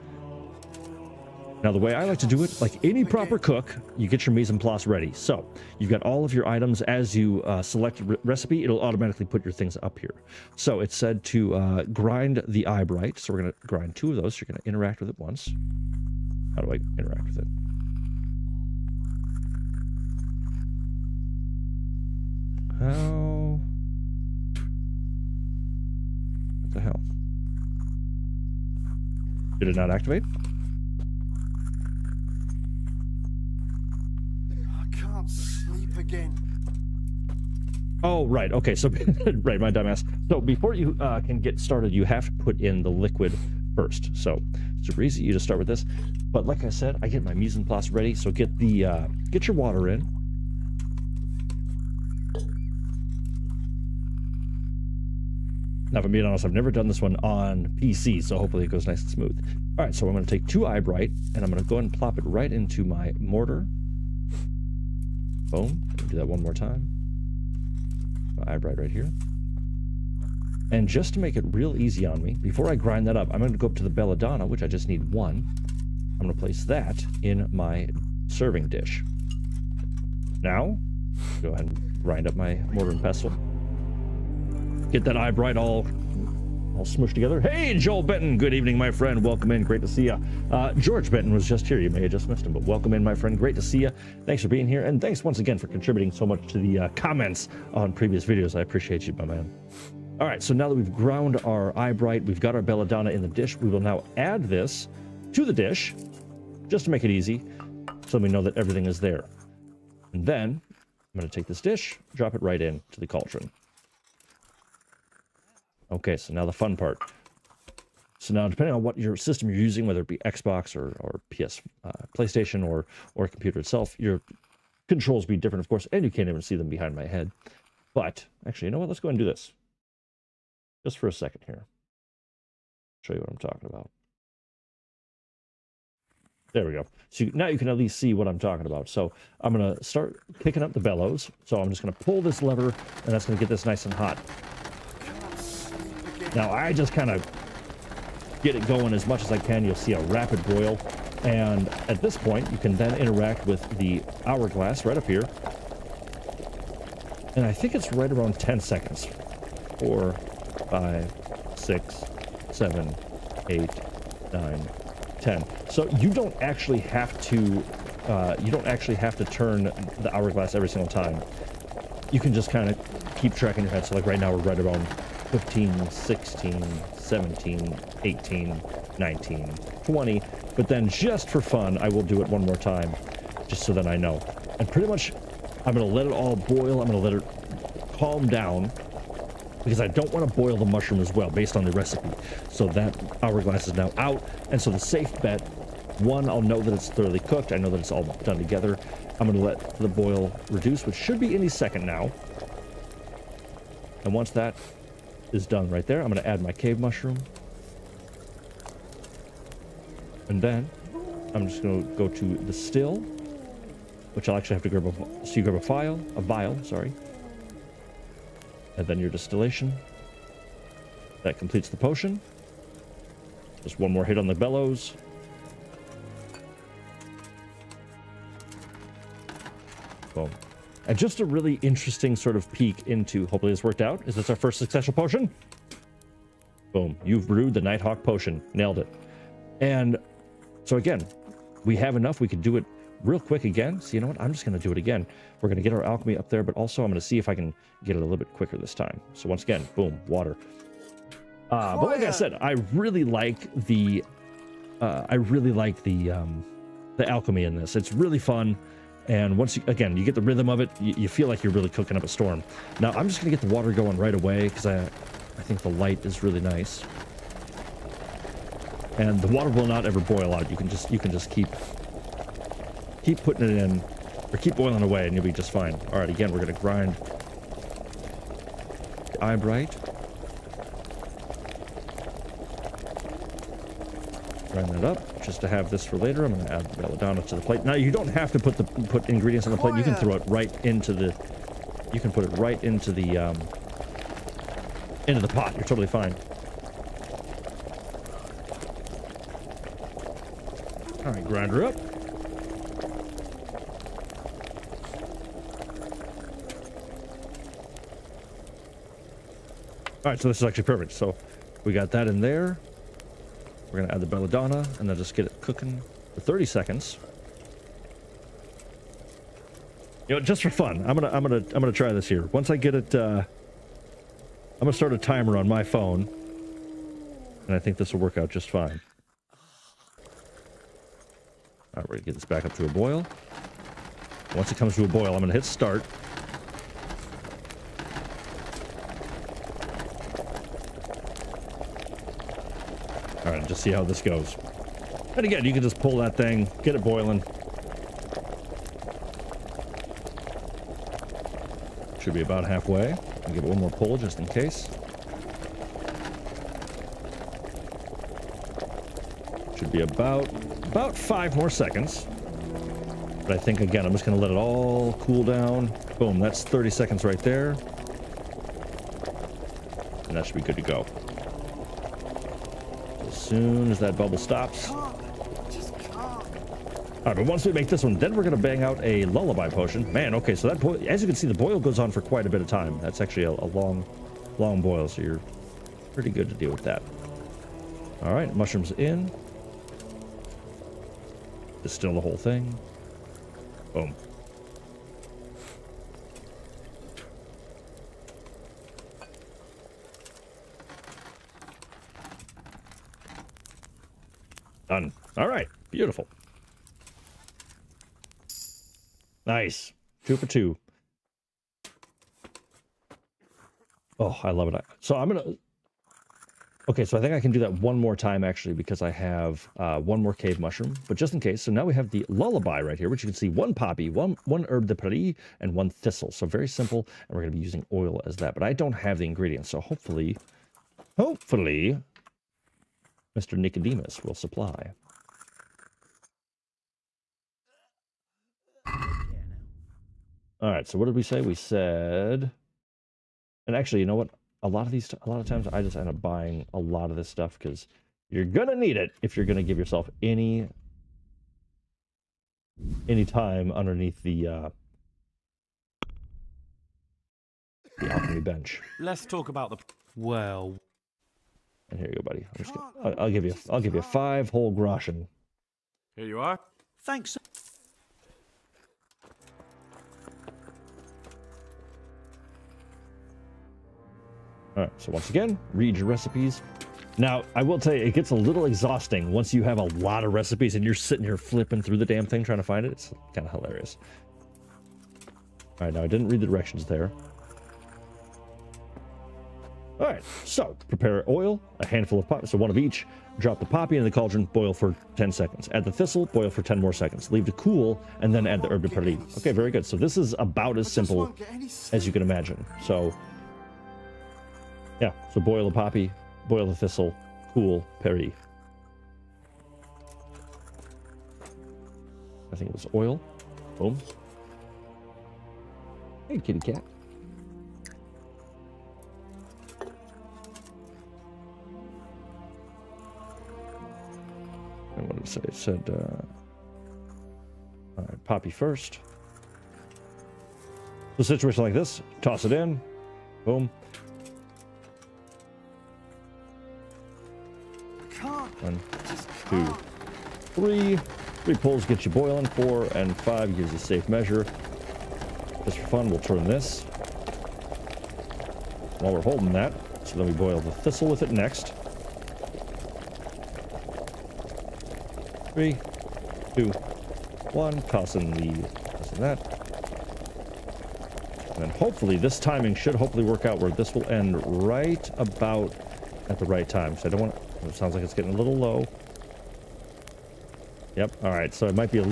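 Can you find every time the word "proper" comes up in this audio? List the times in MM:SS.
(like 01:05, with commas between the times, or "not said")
00:03.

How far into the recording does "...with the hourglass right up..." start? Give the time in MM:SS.
02:33.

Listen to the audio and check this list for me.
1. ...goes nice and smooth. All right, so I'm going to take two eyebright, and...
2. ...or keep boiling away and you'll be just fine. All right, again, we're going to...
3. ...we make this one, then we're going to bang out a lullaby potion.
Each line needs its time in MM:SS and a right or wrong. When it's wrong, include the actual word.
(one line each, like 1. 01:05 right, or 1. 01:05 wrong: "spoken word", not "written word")
1. 00:58 right
2. 04:34 right
3. 06:17 right.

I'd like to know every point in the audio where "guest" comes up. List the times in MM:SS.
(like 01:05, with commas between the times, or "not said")
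not said.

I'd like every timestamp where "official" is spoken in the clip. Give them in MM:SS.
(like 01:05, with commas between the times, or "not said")
not said.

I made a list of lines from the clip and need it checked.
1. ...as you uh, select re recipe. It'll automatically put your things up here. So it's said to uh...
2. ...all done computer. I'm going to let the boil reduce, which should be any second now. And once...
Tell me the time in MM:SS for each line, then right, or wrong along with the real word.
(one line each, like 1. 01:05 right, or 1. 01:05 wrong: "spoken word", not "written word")
1. 00:06 right
2. 03:17 wrong: "together", not "computer".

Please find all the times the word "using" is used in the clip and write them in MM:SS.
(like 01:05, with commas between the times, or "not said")
01:59, 07:07.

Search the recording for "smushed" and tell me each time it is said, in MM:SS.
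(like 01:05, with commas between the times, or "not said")
01:26.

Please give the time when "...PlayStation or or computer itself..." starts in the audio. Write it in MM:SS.
02:02.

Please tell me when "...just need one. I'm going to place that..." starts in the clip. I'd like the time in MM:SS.
01:14.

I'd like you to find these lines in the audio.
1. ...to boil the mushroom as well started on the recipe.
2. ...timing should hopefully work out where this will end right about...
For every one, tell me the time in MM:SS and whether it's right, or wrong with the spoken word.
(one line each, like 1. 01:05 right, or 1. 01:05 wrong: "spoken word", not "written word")
1. 03:10 wrong: "based", not "started"
2. 09:22 right.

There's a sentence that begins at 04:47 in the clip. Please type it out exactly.
Now, you don't have to put the put ingredients on the plate.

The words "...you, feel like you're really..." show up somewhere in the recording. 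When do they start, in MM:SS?
04:20.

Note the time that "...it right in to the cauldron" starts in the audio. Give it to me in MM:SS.
01:52.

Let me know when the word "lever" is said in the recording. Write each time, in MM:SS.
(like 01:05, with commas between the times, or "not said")
02:22.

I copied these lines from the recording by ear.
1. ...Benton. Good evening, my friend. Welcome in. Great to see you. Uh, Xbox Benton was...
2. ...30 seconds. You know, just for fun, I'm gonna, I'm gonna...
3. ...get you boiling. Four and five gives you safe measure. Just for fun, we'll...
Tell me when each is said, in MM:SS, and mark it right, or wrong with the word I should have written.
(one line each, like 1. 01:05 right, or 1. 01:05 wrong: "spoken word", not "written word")
1. 01:28 wrong: "George", not "Xbox"
2. 05:16 right
3. 09:01 right.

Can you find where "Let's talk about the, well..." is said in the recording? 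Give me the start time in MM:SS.
07:38.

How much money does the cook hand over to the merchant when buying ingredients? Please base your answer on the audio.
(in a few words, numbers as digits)
5 groschen.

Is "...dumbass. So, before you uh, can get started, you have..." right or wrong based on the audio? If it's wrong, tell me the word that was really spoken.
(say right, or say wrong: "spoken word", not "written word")
right.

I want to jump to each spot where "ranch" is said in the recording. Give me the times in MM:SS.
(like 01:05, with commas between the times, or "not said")
not said.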